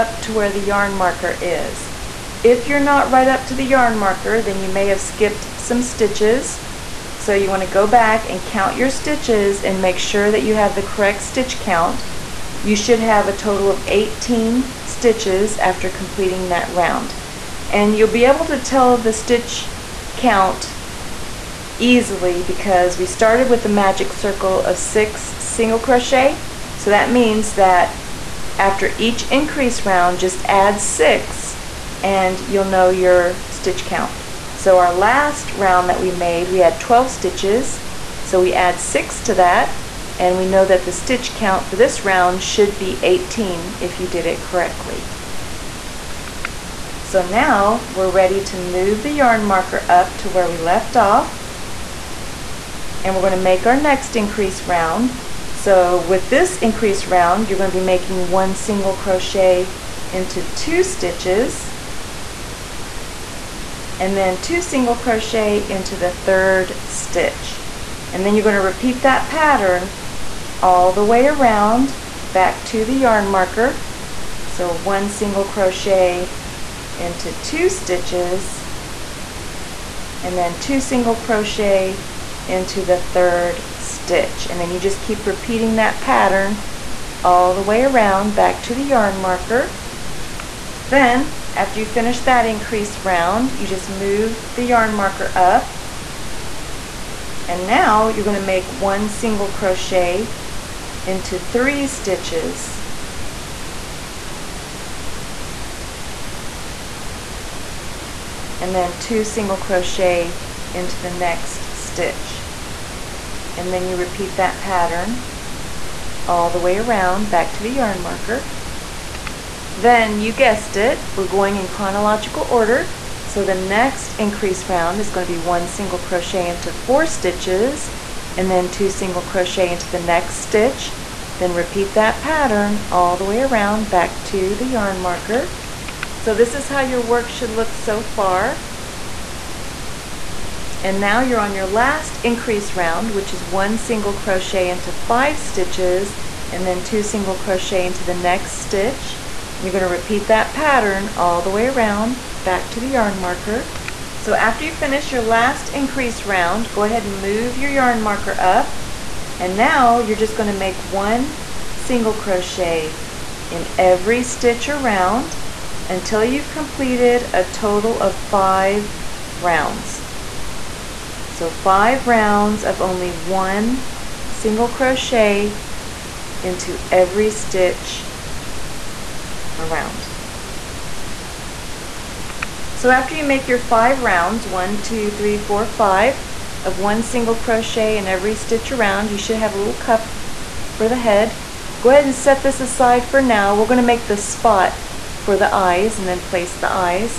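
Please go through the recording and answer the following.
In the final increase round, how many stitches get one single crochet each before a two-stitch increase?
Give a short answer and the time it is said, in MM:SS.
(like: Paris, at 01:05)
5, at 02:24.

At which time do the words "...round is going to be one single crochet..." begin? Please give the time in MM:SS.
02:04.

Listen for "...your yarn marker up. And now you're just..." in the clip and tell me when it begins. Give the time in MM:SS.
02:37.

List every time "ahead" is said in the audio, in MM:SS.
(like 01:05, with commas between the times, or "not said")
02:36, 03:11.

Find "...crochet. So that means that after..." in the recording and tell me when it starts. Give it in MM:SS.
00:25.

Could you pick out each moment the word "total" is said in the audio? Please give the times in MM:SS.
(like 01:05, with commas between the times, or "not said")
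00:13, 02:47.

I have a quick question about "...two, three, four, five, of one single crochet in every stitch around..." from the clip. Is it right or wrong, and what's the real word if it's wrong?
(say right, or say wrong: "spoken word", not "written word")
right.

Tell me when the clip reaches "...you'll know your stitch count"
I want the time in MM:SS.
00:32.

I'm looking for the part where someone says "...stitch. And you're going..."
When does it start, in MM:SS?
02:28.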